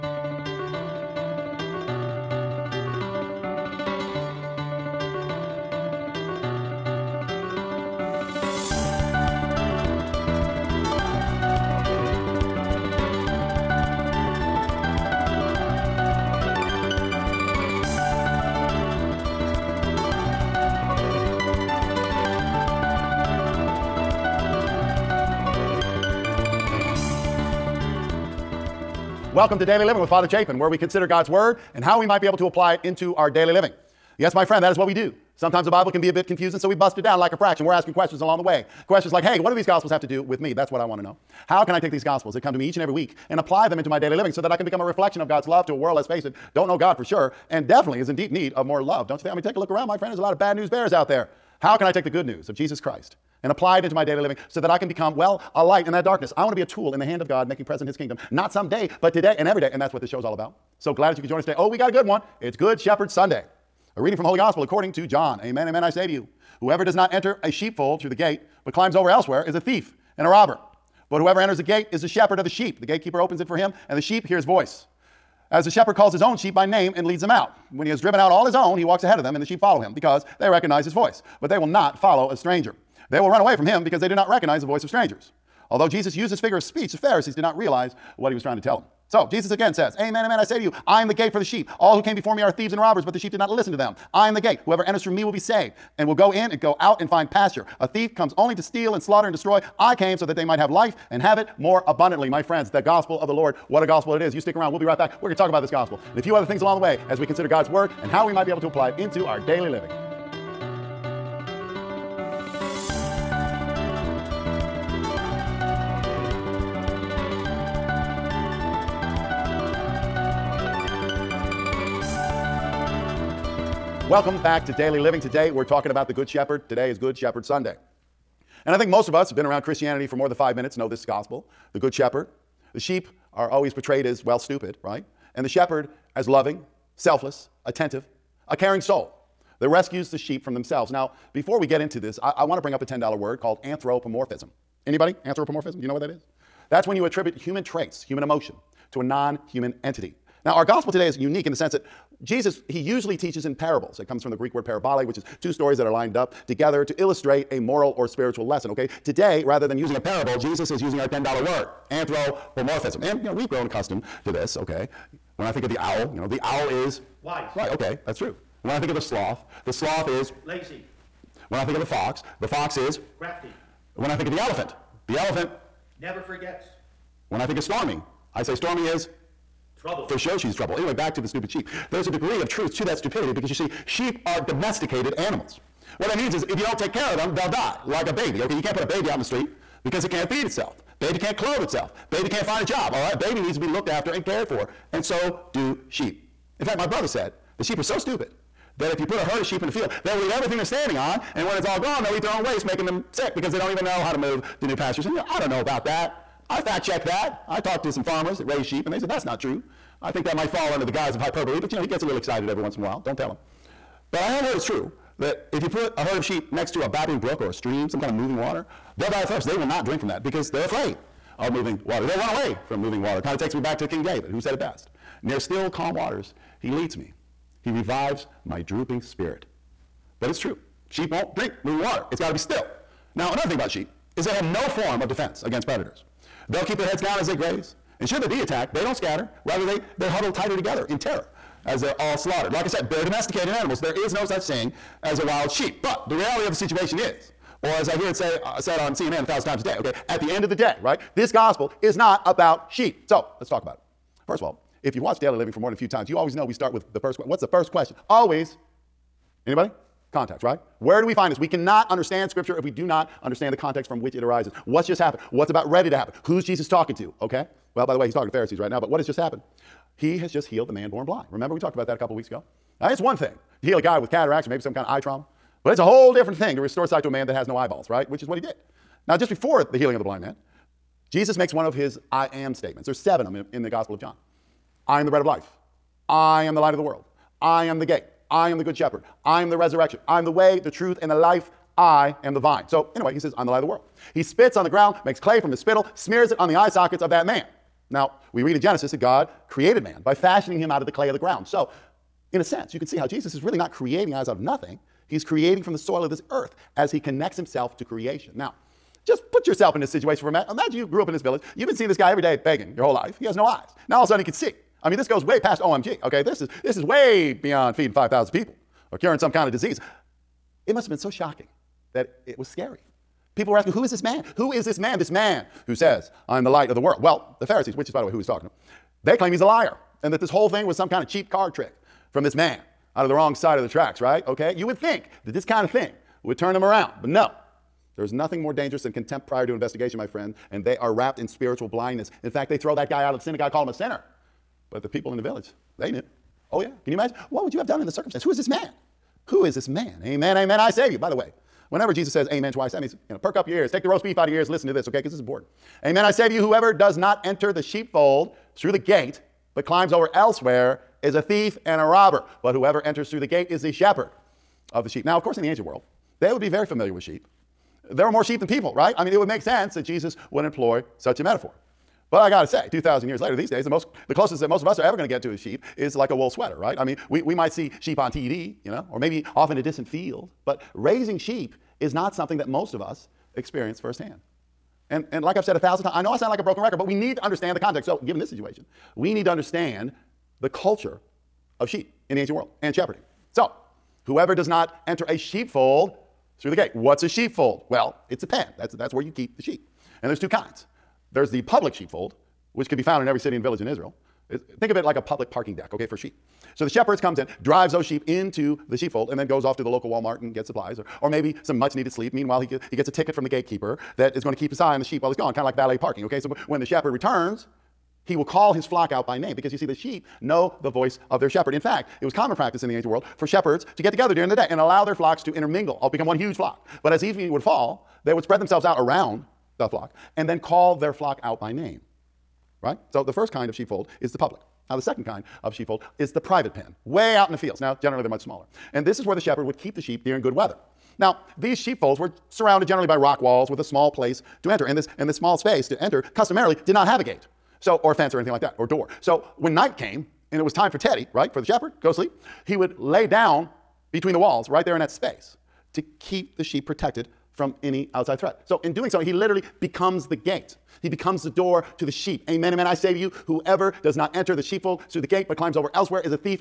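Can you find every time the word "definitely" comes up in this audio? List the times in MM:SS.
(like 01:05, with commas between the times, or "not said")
00:47.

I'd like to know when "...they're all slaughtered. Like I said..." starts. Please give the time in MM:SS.
04:01.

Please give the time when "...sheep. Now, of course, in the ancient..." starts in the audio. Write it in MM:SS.
06:04.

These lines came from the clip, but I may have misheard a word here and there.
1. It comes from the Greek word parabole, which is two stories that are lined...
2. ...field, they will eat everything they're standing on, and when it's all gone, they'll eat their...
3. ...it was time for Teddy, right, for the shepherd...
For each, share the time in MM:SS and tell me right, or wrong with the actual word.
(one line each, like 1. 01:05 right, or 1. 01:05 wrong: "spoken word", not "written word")
1. 02:33 right
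2. 03:19 right
3. 07:30 right.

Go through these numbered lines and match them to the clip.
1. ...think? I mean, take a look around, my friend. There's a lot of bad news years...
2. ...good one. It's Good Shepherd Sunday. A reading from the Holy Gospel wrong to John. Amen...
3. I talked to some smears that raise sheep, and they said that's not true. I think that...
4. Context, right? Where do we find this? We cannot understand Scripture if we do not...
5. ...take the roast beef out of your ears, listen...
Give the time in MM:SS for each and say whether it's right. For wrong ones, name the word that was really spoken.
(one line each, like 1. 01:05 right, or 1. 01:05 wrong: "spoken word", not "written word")
1. 00:49 wrong: "bears", not "years"
2. 01:01 wrong: "according", not "wrong"
3. 03:27 wrong: "farmers", not "smears"
4. 04:20 right
5. 05:53 right.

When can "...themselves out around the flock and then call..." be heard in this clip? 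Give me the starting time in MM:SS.
07:08.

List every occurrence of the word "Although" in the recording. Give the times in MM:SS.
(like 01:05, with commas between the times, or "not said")
01:25.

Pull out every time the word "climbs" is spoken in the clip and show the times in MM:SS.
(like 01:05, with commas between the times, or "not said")
01:08, 05:59, 07:45.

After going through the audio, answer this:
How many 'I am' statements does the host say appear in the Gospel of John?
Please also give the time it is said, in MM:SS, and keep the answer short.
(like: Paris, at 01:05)
7, at 04:42.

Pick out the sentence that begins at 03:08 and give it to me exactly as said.
Okay, you can't put a baby out in the street because it can't feed itself.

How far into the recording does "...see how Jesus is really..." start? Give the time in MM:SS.
05:02.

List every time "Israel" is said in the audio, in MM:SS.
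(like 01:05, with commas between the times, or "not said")
06:43.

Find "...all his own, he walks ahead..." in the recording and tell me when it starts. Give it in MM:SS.
01:18.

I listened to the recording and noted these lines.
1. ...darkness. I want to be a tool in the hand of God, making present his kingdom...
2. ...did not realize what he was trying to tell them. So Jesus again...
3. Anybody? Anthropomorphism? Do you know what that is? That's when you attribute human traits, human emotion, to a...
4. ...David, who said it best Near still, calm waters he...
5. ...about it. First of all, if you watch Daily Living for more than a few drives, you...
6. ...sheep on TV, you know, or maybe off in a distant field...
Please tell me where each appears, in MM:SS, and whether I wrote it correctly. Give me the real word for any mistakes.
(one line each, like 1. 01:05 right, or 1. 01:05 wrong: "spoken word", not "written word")
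1. 00:56 right
2. 01:27 right
3. 02:24 right
4. 03:44 right
5. 04:13 wrong: "times", not "drives"
6. 06:17 right.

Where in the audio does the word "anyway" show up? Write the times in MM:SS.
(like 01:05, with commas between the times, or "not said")
03:00, 04:52.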